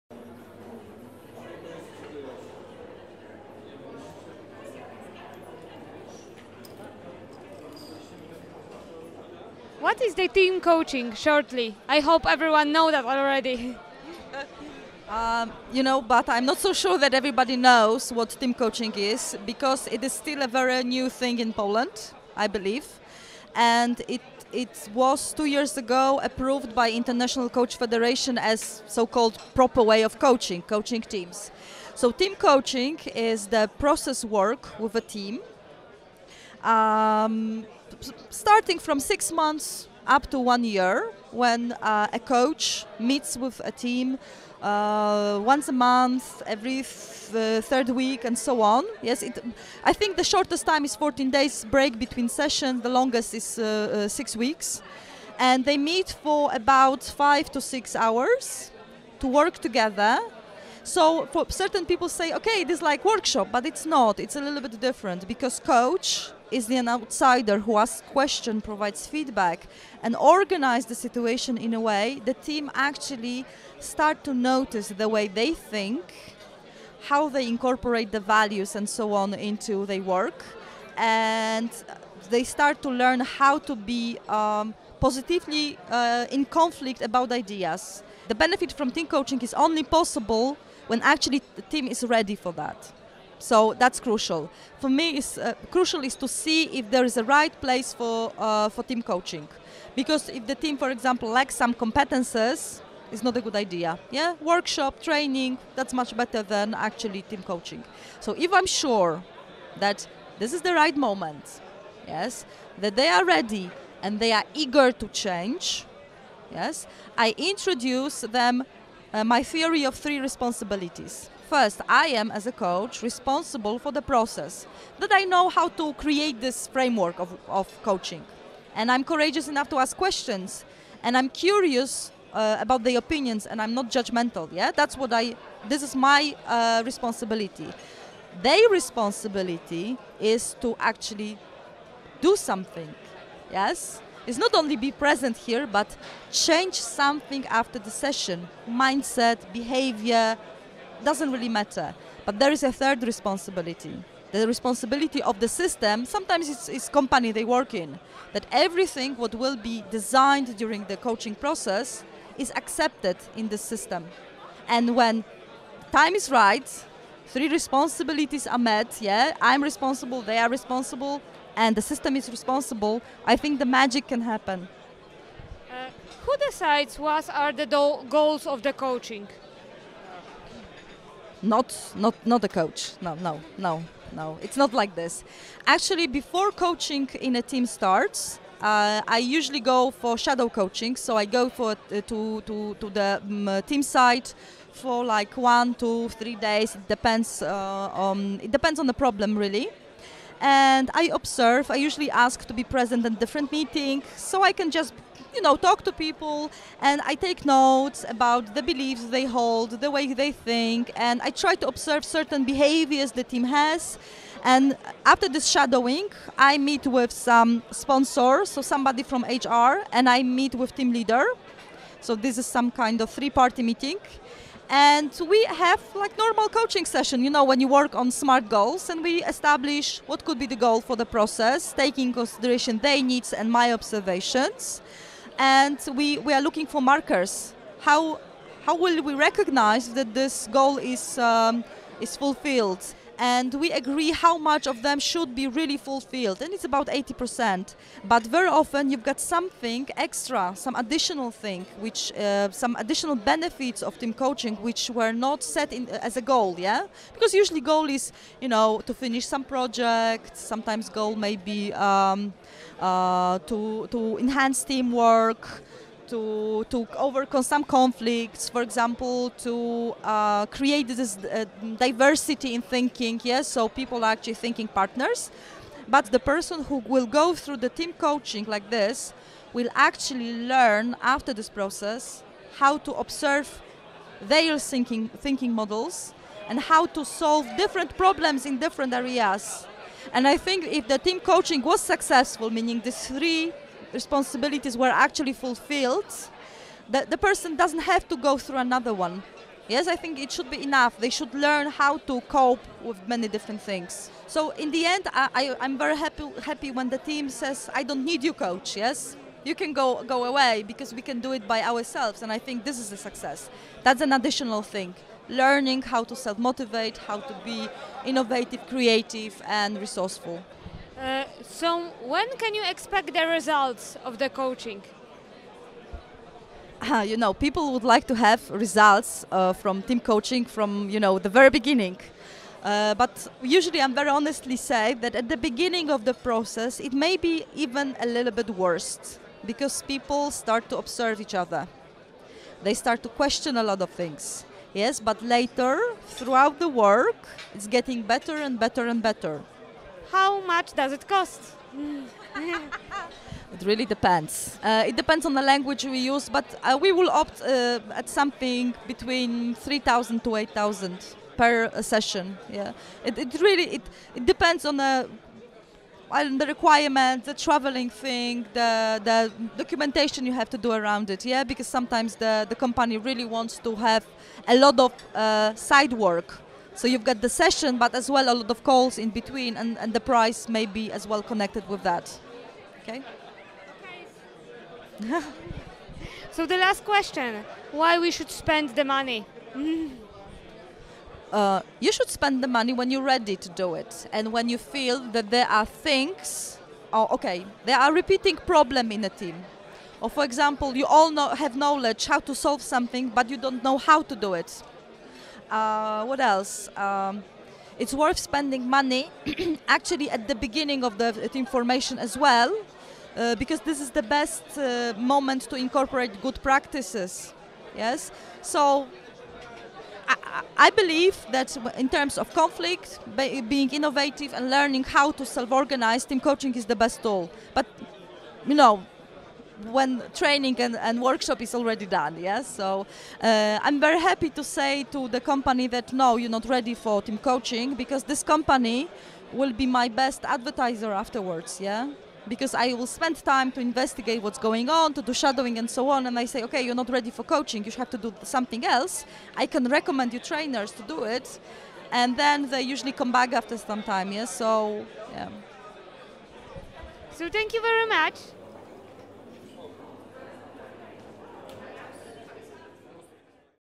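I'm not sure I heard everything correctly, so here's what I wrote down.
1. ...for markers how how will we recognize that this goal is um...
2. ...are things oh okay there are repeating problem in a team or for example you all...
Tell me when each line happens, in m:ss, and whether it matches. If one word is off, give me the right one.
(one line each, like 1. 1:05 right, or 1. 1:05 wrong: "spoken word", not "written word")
1. 3:56 right
2. 6:35 right.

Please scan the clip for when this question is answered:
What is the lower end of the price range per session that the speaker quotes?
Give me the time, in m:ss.
5:59.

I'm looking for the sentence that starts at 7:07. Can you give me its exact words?
But, you know, when training and, and workshop is already done.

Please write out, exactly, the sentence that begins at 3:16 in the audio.
It depends uh, on um, it depends on the problem really and I observe.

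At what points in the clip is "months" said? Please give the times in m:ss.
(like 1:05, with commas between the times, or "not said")
0:39, 0:45.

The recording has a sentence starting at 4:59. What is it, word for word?
Yes, I think it should be enough.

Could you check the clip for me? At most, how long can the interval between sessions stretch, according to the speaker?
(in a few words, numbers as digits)
6 weeks.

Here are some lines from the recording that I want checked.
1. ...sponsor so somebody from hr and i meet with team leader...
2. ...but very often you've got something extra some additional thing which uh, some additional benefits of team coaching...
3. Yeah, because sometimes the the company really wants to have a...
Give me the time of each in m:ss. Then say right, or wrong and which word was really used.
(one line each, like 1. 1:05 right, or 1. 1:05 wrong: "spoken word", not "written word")
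1. 3:37 right
2. 4:08 right
3. 6:11 right.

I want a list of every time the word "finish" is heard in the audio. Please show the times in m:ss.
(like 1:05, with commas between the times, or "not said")
4:18.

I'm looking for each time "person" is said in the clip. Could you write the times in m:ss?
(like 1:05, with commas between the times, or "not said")
4:36, 4:57.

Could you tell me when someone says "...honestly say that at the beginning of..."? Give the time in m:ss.
5:34.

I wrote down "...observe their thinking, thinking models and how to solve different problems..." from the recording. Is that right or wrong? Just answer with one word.
right.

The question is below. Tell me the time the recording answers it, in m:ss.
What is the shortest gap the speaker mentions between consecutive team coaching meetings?
0:50.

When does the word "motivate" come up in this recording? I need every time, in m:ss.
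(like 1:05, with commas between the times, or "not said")
5:16.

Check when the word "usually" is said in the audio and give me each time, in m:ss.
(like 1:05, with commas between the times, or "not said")
3:09, 3:21, 4:17, 5:33, 7:32.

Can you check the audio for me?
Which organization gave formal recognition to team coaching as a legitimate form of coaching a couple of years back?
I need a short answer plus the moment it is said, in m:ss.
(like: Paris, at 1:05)
International Coach Federation, at 0:26.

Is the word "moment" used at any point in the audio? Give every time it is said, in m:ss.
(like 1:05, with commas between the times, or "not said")
1:50, 6:54.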